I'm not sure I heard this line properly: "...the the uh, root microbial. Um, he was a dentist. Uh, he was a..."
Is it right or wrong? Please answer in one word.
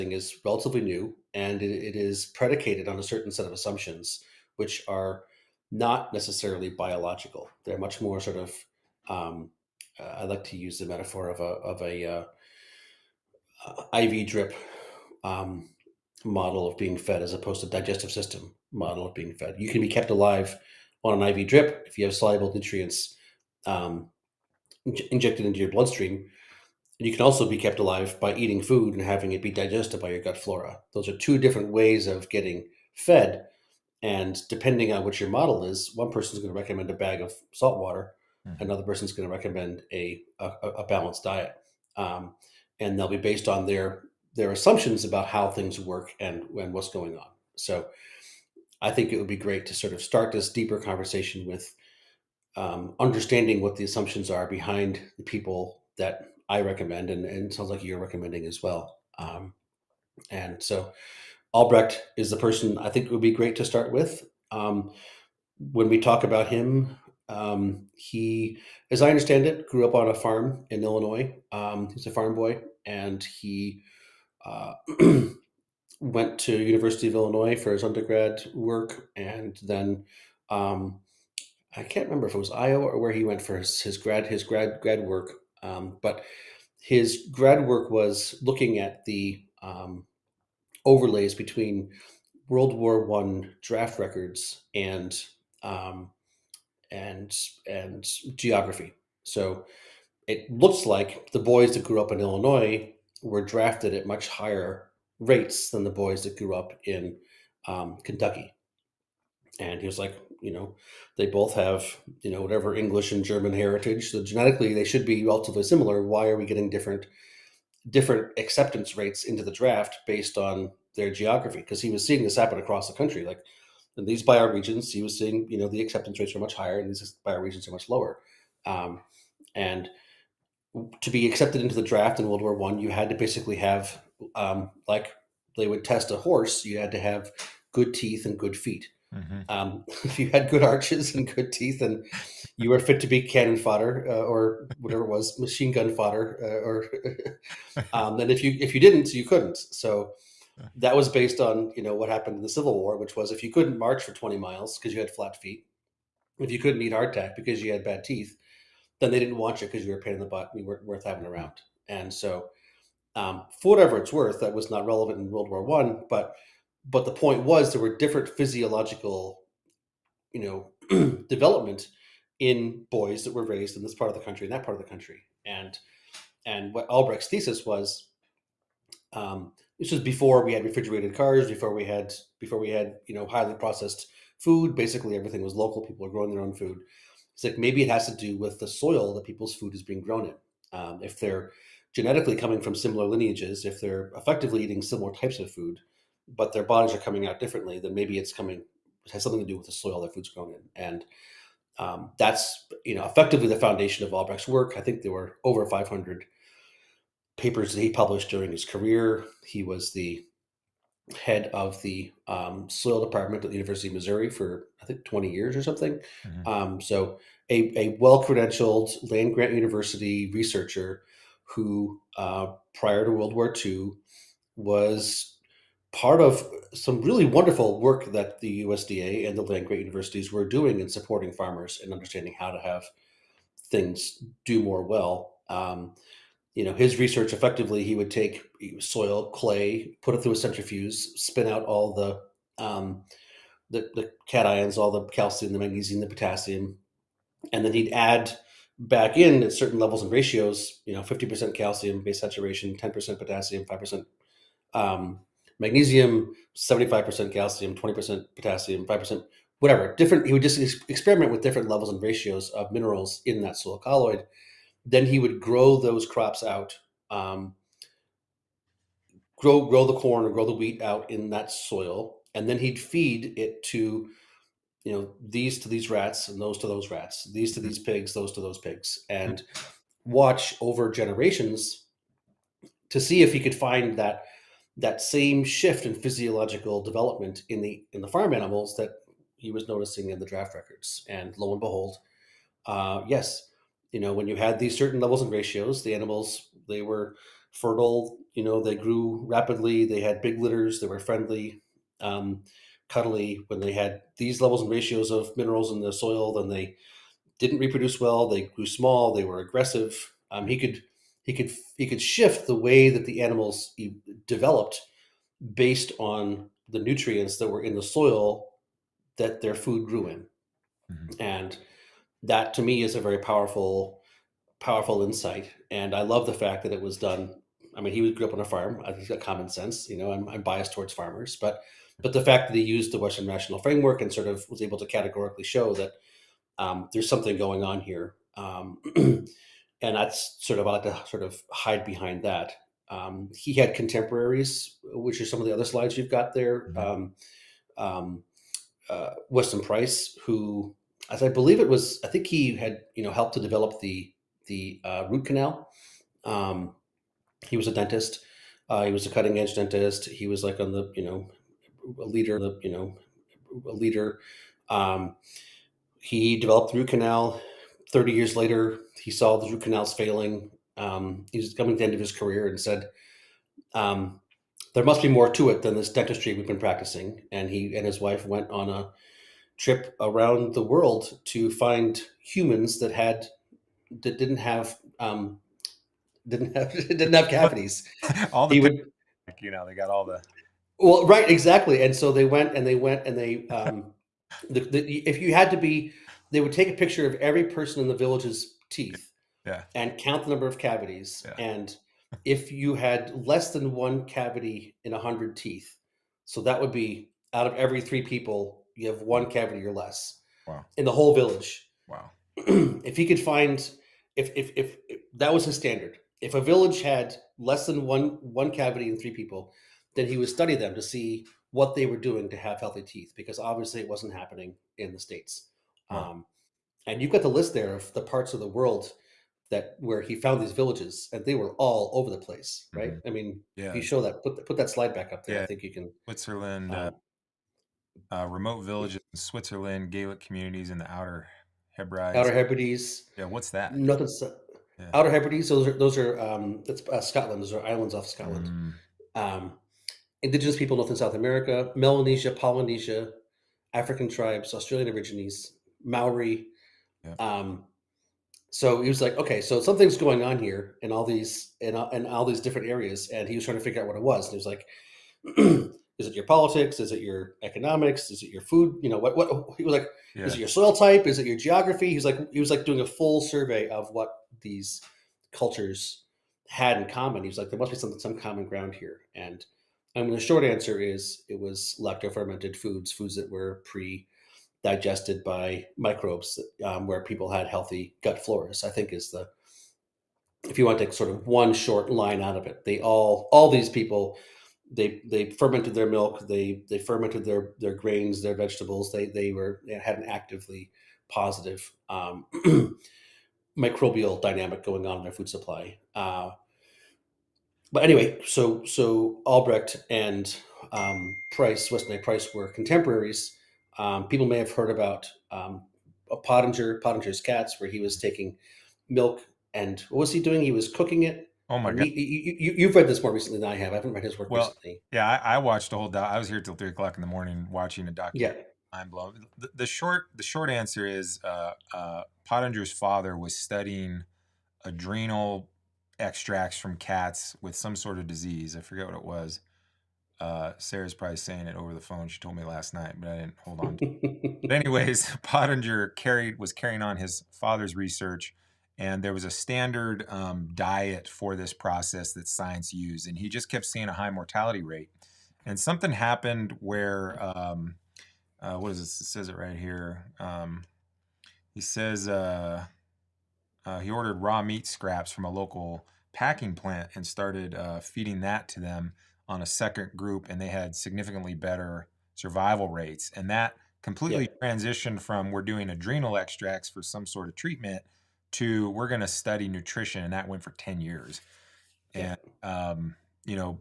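wrong.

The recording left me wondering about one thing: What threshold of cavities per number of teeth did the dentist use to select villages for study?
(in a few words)
1 cavity in 100 teeth.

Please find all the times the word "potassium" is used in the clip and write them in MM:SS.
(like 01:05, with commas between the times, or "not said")
04:06, 04:13, 04:18.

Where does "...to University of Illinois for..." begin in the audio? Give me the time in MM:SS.
01:16.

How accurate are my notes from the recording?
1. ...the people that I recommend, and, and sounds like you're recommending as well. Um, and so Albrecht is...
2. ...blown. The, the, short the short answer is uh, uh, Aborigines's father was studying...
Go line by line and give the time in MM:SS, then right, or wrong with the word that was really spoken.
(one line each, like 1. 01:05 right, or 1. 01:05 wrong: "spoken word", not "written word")
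1. 00:55 right
2. 08:48 wrong: "Pottenger", not "Aborigines".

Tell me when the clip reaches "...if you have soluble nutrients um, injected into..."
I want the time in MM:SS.
00:21.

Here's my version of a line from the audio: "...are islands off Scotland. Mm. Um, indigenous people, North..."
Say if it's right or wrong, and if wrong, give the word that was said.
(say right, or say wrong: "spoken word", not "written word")
right.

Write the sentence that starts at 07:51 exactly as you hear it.
He's like, he was like doing a full survey of what these cultures had in common.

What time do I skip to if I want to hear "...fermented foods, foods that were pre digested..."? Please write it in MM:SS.
08:02.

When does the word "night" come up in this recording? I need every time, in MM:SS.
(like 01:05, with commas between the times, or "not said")
09:02.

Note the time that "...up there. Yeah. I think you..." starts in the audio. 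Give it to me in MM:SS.
07:15.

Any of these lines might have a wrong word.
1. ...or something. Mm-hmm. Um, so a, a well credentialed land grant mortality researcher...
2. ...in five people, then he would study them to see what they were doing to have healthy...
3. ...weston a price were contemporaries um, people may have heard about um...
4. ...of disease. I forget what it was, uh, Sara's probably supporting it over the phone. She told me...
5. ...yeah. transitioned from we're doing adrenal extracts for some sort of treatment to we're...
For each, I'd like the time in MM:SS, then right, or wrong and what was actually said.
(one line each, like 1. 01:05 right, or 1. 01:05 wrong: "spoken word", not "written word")
1. 03:35 wrong: "university", not "mortality"
2. 06:58 wrong: "three", not "five"
3. 08:31 right
4. 08:57 wrong: "saying", not "supporting"
5. 09:34 right.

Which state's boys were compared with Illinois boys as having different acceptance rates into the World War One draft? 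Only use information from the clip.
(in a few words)
Kentucky.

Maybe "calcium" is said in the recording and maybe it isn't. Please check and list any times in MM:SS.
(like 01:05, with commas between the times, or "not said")
04:05, 04:11, 04:17.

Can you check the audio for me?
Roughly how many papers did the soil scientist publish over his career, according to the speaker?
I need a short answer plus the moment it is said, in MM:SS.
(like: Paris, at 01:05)
500, at 03:25.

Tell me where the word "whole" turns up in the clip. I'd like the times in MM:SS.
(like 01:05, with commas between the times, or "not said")
06:50, 08:45.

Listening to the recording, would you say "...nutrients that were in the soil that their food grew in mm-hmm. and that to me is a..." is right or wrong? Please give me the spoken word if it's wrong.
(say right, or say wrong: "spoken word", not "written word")
right.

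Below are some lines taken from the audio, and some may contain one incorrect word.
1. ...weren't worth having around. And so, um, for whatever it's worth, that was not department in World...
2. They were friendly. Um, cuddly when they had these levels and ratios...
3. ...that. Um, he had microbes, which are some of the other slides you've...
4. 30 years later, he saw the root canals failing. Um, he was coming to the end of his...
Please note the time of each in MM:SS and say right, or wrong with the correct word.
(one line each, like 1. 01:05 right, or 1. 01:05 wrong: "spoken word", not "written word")
1. 02:40 wrong: "relevant", not "department"
2. 05:00 right
3. 05:42 wrong: "contemporaries", not "microbes"
4. 06:07 right.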